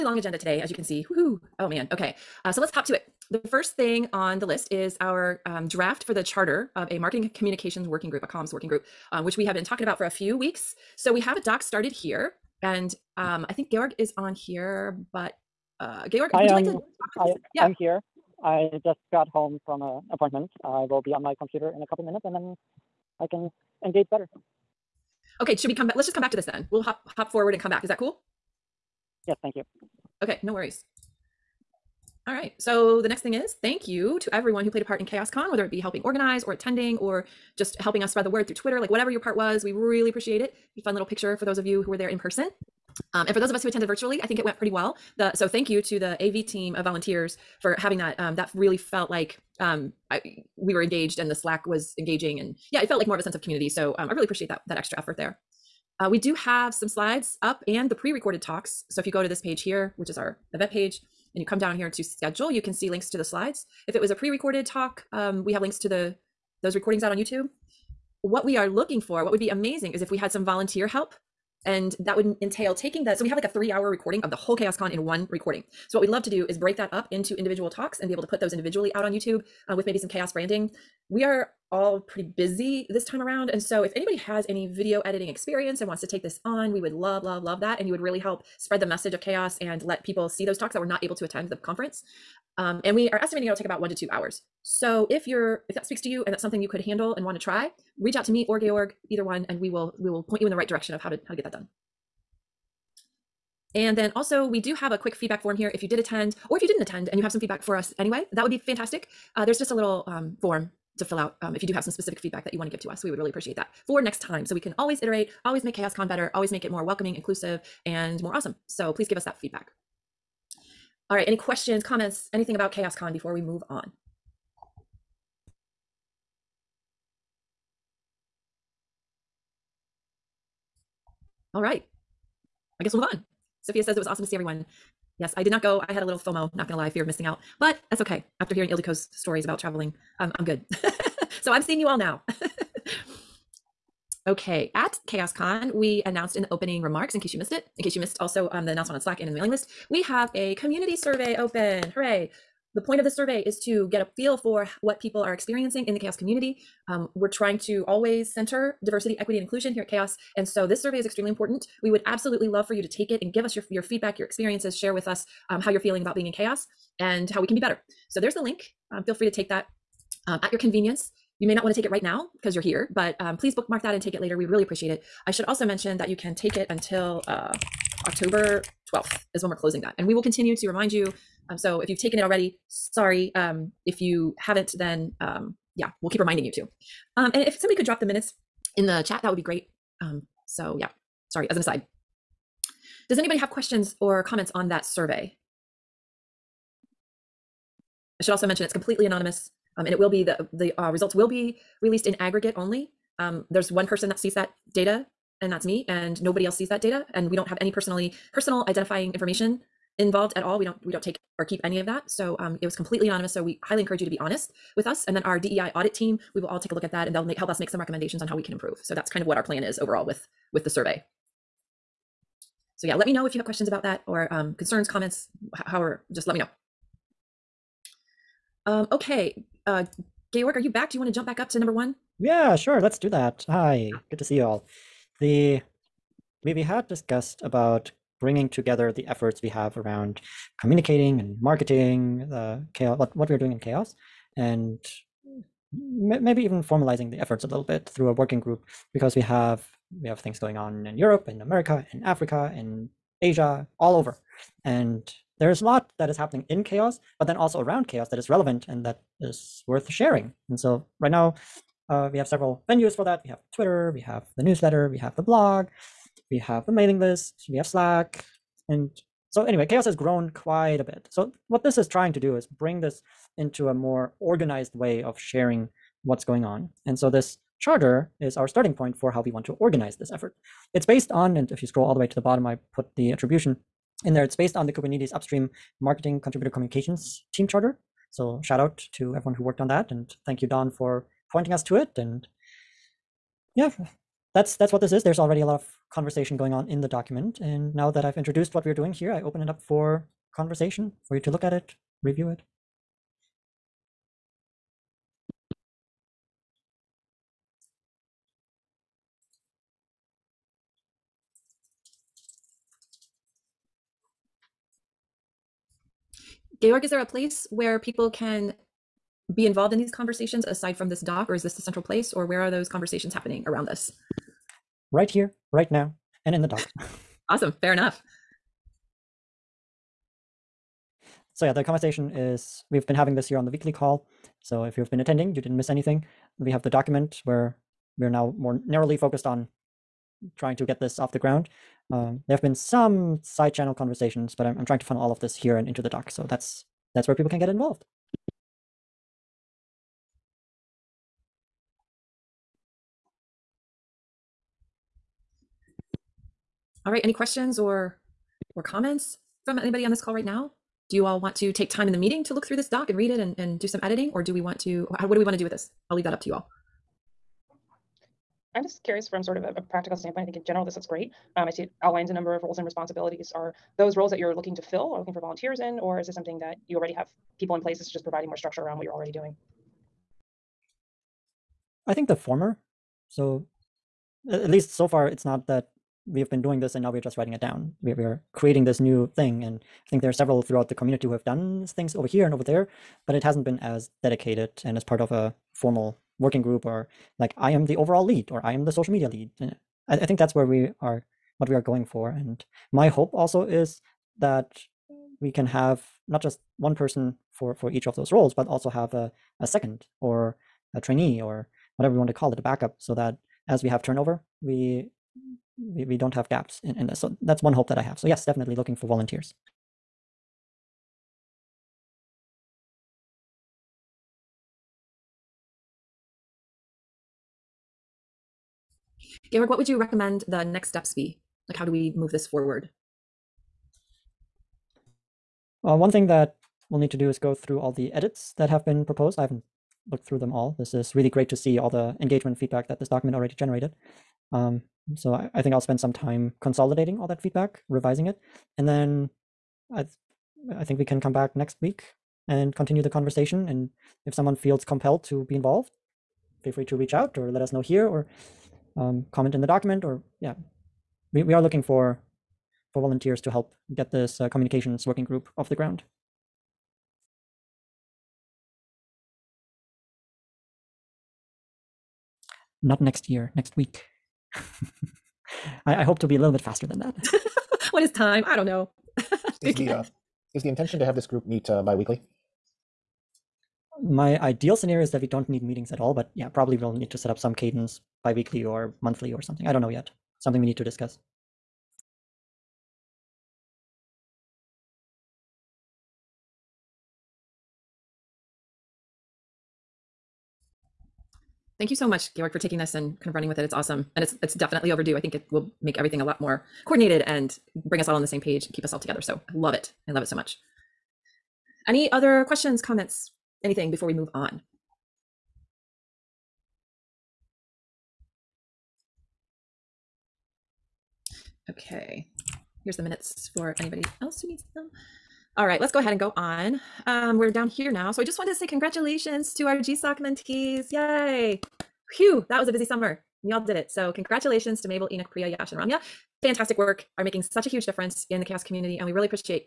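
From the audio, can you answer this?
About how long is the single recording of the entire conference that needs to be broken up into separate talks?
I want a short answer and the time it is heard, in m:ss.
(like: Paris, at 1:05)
3 hours, at 1:13.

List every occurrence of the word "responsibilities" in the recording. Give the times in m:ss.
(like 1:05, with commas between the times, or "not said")
6:12.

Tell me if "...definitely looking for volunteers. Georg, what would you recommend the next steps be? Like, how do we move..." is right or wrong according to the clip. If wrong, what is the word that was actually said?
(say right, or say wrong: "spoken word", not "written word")
right.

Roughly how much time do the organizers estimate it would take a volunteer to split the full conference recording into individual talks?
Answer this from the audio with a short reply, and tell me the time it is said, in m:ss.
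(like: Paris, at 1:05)
1 to 2 hours, at 1:33.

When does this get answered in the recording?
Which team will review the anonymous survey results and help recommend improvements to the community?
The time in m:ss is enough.
3:35.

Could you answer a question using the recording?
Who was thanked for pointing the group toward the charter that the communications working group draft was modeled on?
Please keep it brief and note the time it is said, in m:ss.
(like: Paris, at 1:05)
Don, at 4:50.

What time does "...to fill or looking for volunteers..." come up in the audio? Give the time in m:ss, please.
6:14.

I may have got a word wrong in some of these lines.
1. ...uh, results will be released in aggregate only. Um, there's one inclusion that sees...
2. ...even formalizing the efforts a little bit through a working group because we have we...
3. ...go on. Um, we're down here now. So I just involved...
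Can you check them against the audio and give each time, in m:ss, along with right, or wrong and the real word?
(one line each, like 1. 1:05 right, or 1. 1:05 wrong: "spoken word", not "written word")
1. 3:20 wrong: "person", not "inclusion"
2. 4:06 right
3. 8:45 wrong: "wanted", not "involved".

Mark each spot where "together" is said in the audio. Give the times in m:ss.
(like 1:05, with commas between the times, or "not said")
3:58, 8:28.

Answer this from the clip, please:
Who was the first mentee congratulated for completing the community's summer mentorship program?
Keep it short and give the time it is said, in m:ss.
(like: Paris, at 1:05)
Mabel, at 8:54.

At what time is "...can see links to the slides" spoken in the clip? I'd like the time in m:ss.
1:02.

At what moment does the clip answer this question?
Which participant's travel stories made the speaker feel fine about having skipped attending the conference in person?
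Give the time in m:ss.
2:18.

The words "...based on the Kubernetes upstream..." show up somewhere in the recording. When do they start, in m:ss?
4:44.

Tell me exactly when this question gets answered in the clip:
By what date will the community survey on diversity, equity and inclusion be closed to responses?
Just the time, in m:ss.
2:58.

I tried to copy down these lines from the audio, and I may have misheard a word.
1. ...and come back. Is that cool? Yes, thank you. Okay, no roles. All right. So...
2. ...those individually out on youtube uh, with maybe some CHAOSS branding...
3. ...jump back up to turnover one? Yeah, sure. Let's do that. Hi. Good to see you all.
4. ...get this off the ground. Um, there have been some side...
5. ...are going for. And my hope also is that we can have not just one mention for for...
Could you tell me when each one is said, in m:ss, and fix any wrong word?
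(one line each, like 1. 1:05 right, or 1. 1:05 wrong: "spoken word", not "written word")
1. 0:27 wrong: "worries", not "roles"
2. 1:18 right
3. 3:51 wrong: "number", not "turnover"
4. 5:40 right
5. 6:41 wrong: "person", not "mention".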